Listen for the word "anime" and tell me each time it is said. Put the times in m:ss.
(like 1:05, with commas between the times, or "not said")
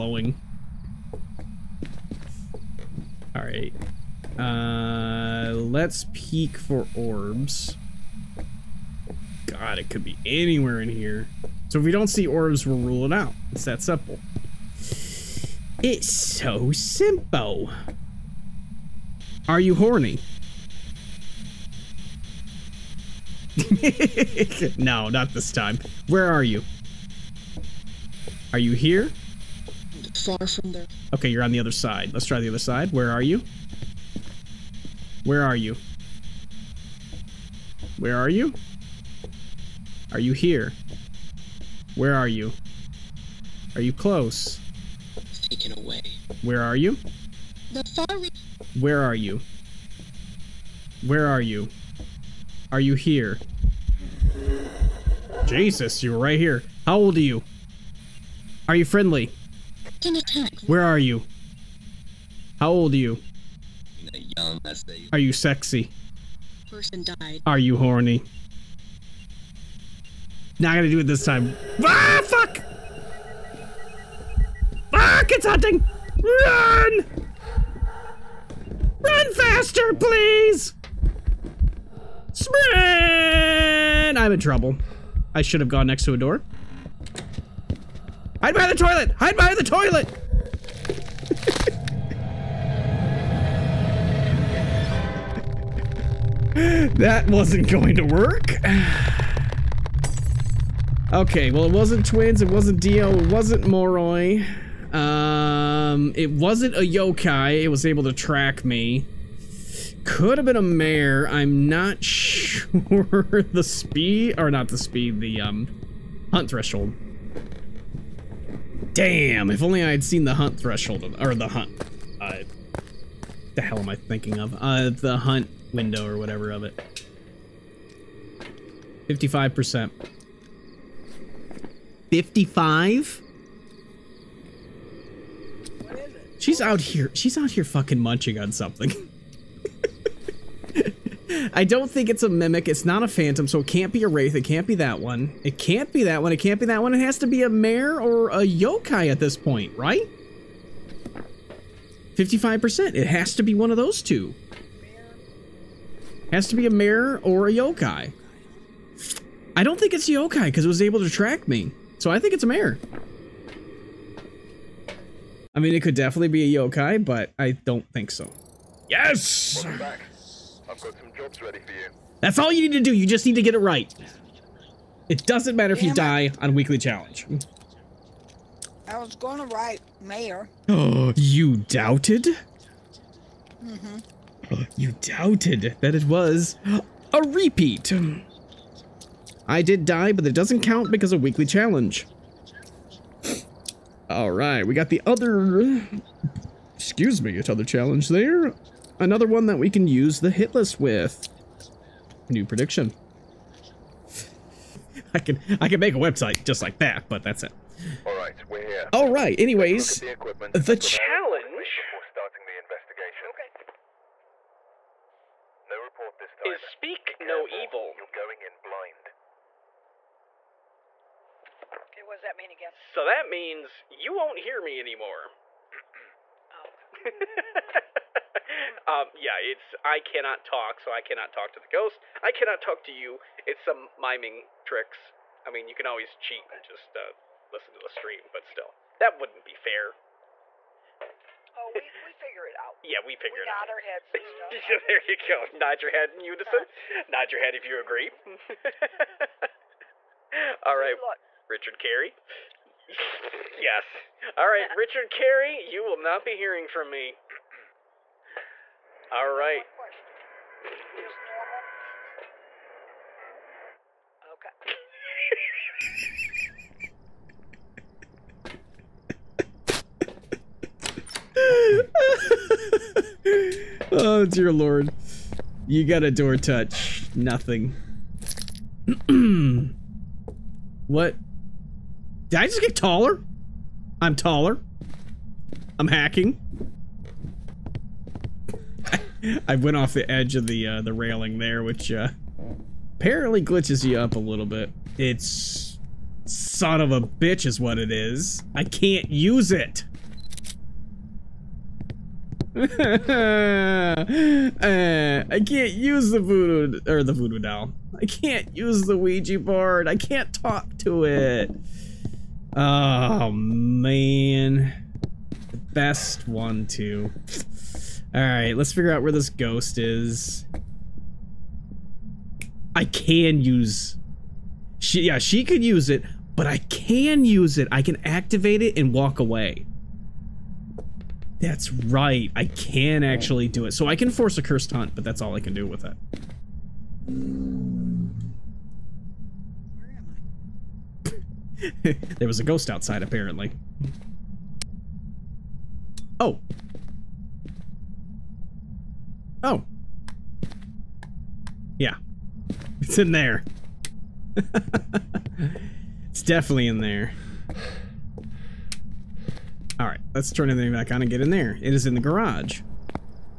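not said.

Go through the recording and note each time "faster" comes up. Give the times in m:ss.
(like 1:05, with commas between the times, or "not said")
1:19.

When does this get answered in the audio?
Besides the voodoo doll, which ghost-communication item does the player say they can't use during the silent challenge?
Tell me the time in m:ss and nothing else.
5:08.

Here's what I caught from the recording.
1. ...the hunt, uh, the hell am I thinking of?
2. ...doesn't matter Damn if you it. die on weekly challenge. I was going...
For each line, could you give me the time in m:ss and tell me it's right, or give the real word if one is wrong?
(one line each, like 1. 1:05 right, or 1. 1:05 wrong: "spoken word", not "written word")
1. 2:01 right
2. 2:55 right.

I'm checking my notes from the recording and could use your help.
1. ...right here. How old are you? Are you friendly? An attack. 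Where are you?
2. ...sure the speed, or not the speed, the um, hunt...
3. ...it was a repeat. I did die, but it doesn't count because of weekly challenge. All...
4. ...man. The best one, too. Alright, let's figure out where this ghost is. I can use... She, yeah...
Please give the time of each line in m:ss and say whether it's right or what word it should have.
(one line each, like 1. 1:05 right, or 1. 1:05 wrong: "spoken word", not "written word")
1. 0:56 right
2. 1:52 right
3. 3:05 right
4. 5:13 right.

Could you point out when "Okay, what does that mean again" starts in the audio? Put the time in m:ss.
3:41.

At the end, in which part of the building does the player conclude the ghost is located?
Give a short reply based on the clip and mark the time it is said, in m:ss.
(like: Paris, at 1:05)
The garage, at 6:02.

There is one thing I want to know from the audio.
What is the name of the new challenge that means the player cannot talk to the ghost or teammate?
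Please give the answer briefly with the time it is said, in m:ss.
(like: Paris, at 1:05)
Speak no evil, at 3:36.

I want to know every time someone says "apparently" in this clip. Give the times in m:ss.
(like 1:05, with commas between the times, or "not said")
4:52, 5:43.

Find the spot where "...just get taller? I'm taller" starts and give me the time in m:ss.
4:42.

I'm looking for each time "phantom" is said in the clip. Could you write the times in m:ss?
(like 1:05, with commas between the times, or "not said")
2:23.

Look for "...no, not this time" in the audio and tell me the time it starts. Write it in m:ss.
0:24.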